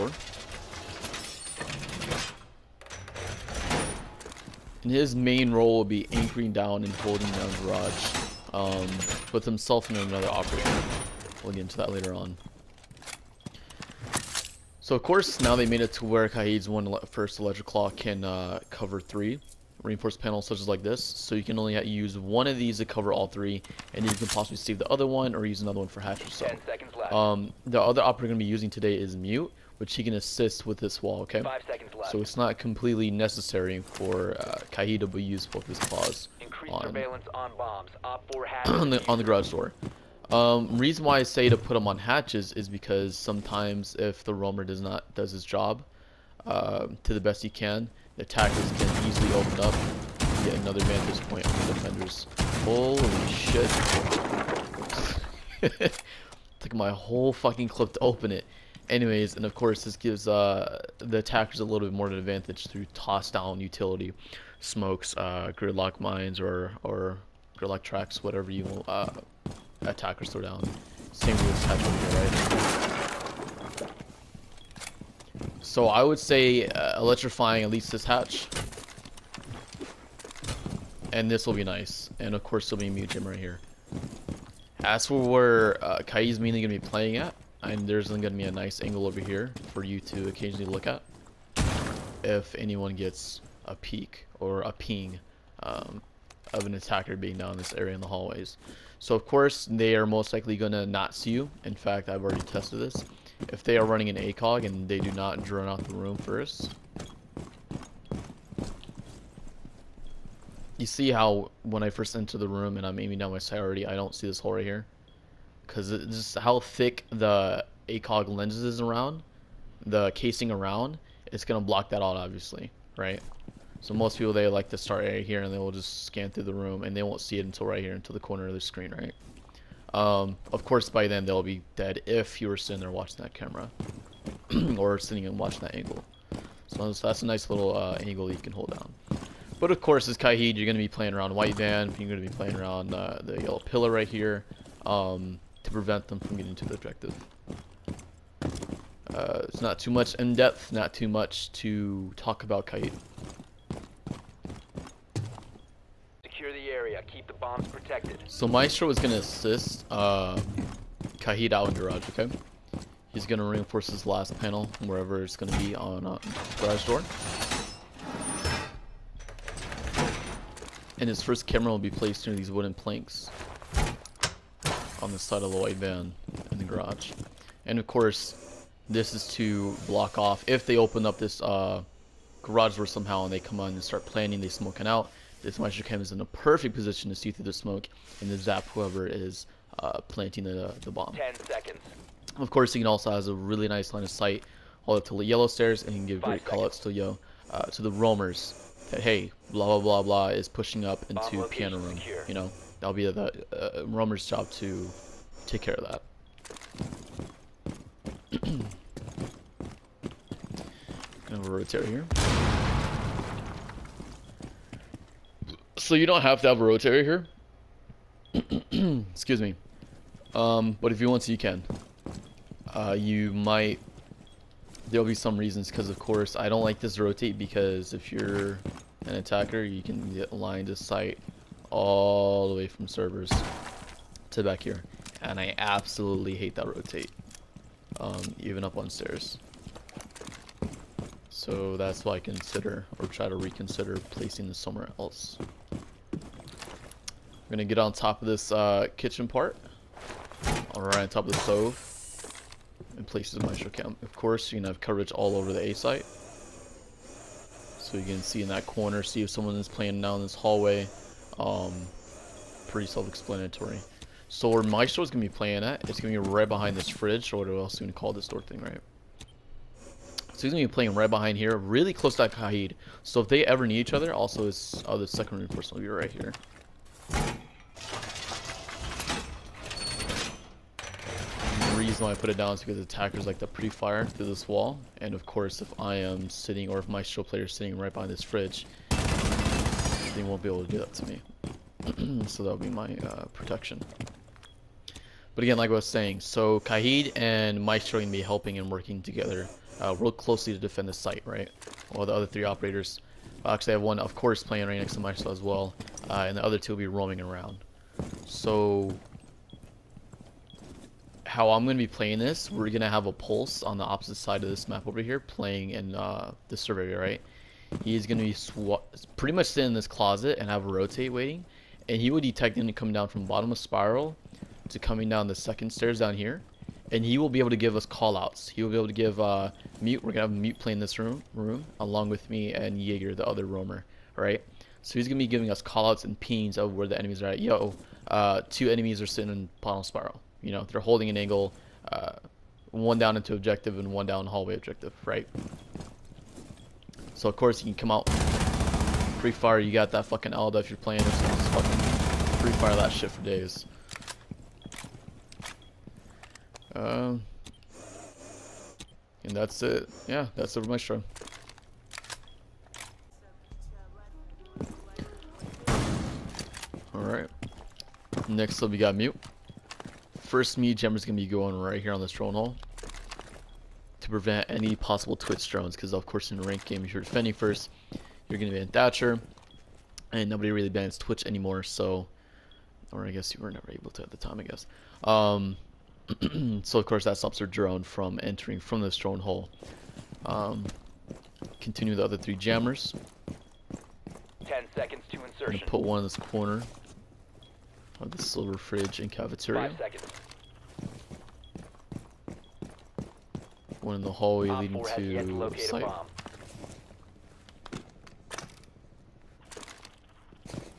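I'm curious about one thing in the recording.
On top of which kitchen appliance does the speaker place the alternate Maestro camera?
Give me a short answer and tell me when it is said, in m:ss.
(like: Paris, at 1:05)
the stove, at 4:11.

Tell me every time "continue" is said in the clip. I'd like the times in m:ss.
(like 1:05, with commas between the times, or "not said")
6:31.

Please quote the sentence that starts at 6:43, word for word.
One in the hallway leading to the site.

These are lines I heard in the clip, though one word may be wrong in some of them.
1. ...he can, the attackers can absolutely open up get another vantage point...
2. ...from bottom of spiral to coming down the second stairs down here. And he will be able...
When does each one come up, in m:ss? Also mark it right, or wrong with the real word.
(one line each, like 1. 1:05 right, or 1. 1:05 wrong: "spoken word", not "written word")
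1. 0:47 wrong: "easily", not "absolutely"
2. 5:23 right.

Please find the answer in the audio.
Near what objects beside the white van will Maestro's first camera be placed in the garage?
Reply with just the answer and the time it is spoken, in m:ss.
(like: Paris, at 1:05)
wooden planks, at 2:52.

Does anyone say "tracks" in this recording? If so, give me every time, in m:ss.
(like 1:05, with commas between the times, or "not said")
1:07.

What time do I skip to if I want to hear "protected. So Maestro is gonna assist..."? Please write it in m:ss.
2:37.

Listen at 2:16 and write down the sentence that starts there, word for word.
So that's a nice little uh, angle you can hold down.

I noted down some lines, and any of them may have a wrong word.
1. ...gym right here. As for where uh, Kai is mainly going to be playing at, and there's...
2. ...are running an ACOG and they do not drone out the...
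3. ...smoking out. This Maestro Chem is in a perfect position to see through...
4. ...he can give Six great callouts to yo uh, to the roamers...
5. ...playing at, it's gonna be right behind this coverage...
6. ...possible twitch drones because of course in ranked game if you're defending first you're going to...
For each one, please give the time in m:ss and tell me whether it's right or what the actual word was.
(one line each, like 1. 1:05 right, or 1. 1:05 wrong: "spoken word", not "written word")
1. 1:23 right
2. 1:43 right
3. 3:04 right
4. 3:15 wrong: "Five", not "Six"
5. 4:25 wrong: "fridge", not "coverage"
6. 6:14 right.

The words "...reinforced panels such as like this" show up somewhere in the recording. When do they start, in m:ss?
0:19.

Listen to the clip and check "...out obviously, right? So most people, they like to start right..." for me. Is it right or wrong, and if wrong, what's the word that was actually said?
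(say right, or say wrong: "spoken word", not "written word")
right.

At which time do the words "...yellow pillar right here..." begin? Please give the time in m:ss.
2:23.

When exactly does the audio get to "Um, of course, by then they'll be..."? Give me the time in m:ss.
2:09.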